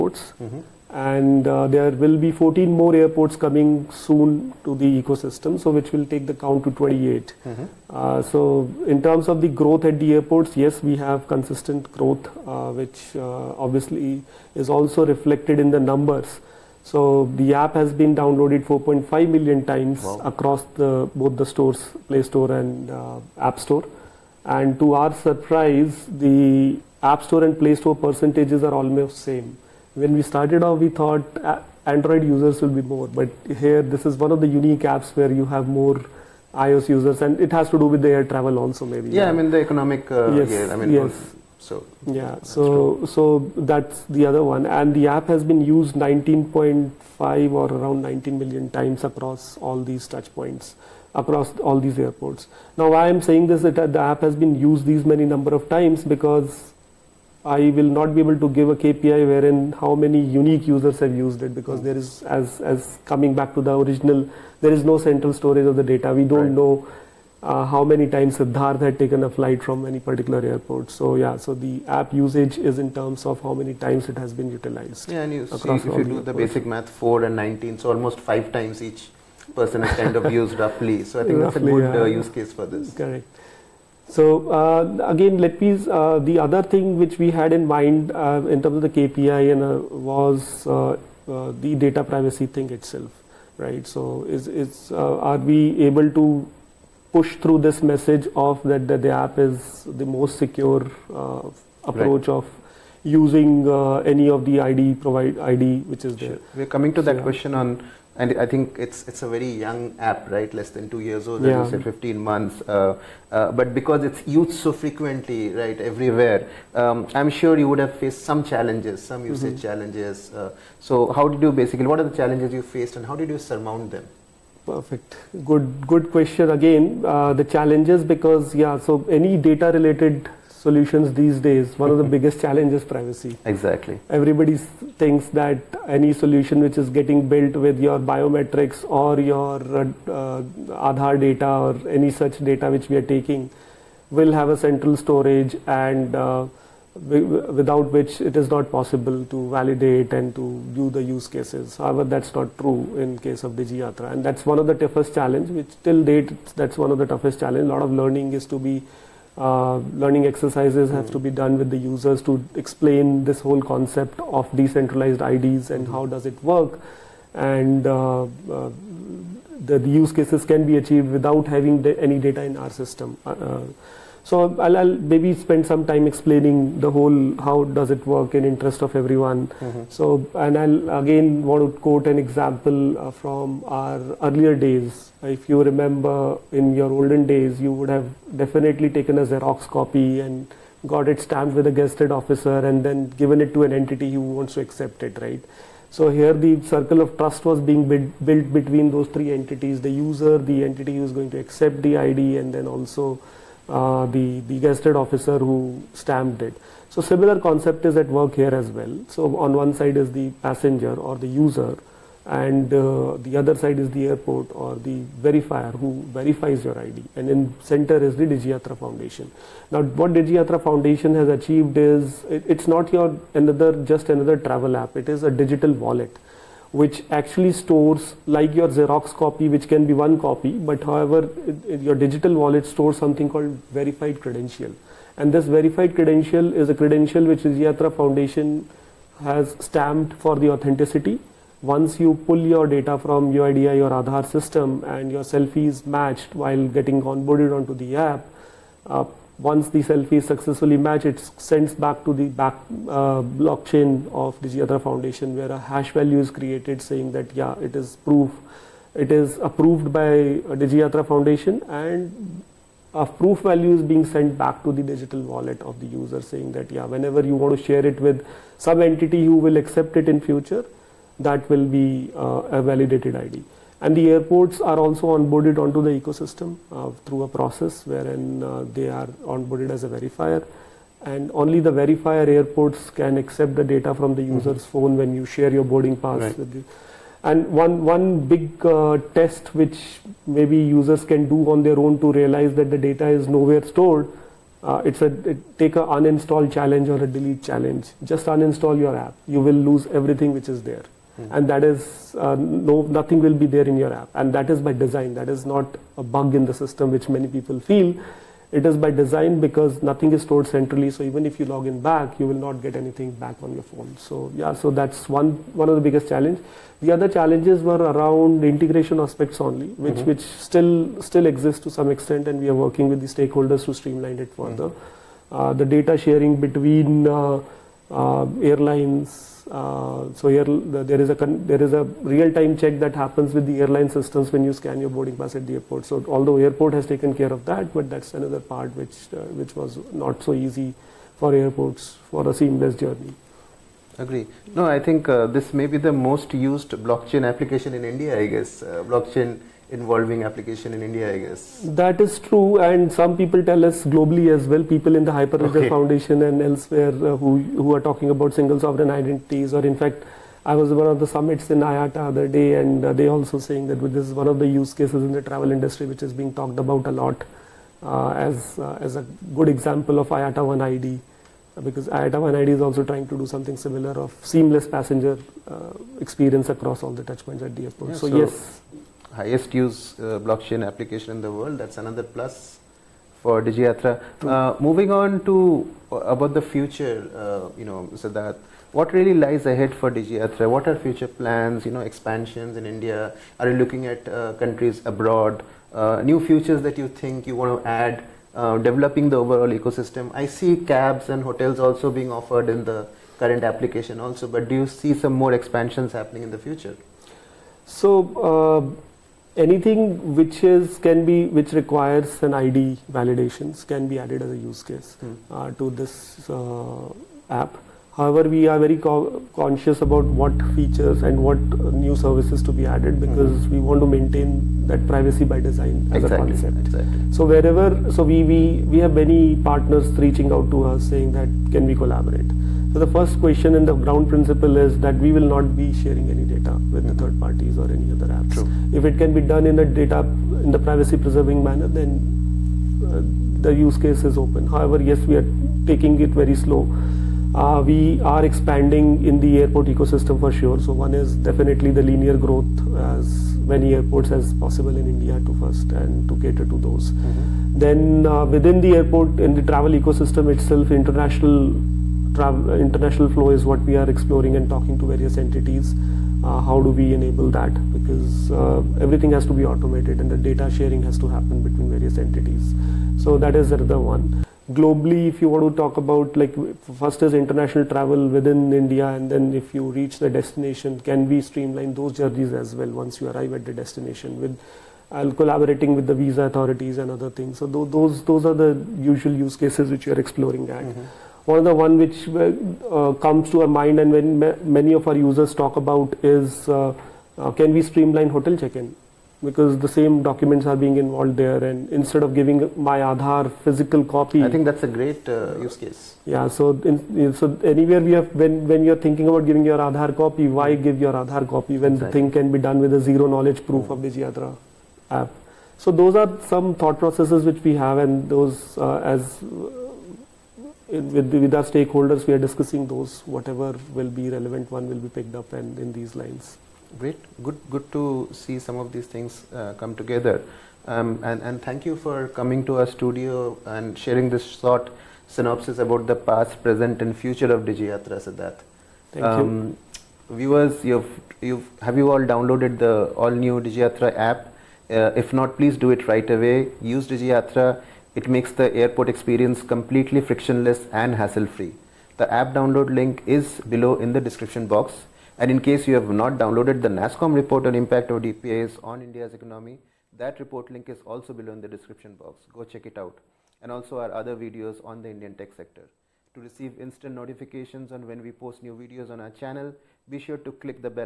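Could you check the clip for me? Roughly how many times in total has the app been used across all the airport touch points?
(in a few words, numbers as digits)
19.5 million.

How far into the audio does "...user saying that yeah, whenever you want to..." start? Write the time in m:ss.
4:25.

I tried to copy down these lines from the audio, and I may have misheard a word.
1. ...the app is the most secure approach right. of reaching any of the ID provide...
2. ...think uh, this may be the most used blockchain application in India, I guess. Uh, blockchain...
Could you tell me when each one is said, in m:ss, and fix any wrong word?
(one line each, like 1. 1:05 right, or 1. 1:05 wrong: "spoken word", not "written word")
1. 1:39 wrong: "using", not "reaching"
2. 5:44 right.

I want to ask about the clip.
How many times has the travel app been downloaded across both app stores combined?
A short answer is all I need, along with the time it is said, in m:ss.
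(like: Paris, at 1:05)
4.5 million, at 0:18.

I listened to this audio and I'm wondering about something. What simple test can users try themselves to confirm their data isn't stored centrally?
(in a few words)
Uninstall challenge.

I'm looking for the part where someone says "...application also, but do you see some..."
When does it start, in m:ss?
6:43.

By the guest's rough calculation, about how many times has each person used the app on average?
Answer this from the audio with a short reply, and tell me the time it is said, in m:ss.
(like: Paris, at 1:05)
5 times, at 1:18.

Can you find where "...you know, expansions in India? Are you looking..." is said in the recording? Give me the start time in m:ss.
6:31.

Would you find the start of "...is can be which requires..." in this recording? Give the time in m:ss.
6:50.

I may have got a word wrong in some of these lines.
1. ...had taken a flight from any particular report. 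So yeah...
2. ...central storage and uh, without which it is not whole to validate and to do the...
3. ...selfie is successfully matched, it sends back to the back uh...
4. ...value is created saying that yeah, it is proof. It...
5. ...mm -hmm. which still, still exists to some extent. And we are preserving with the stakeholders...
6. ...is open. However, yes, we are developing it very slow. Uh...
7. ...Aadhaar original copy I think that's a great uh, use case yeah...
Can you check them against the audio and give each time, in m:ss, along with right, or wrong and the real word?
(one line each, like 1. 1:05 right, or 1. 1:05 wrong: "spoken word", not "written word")
1. 1:08 wrong: "airport", not "report"
2. 2:24 wrong: "possible", not "whole"
3. 4:09 right
4. 4:15 right
5. 5:19 wrong: "working", not "preserving"
6. 7:24 wrong: "taking", not "developing"
7. 8:22 wrong: "physical", not "original".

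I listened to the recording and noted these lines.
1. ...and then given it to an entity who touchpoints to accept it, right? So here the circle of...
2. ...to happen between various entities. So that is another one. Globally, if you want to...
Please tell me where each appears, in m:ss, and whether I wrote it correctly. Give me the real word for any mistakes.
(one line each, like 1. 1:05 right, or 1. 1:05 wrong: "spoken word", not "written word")
1. 3:12 wrong: "wants", not "touchpoints"
2. 7:50 right.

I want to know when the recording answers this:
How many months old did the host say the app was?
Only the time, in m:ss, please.
1:51.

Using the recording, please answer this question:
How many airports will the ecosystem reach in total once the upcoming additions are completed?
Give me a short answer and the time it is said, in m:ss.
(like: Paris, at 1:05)
28, at 0:06.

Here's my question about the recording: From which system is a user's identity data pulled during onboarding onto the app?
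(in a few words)
UIDAI.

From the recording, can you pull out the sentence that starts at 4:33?
And the airports are also onboarded onto the ecosystem uh, through a process wherein uh, they are onboarded as a verifier.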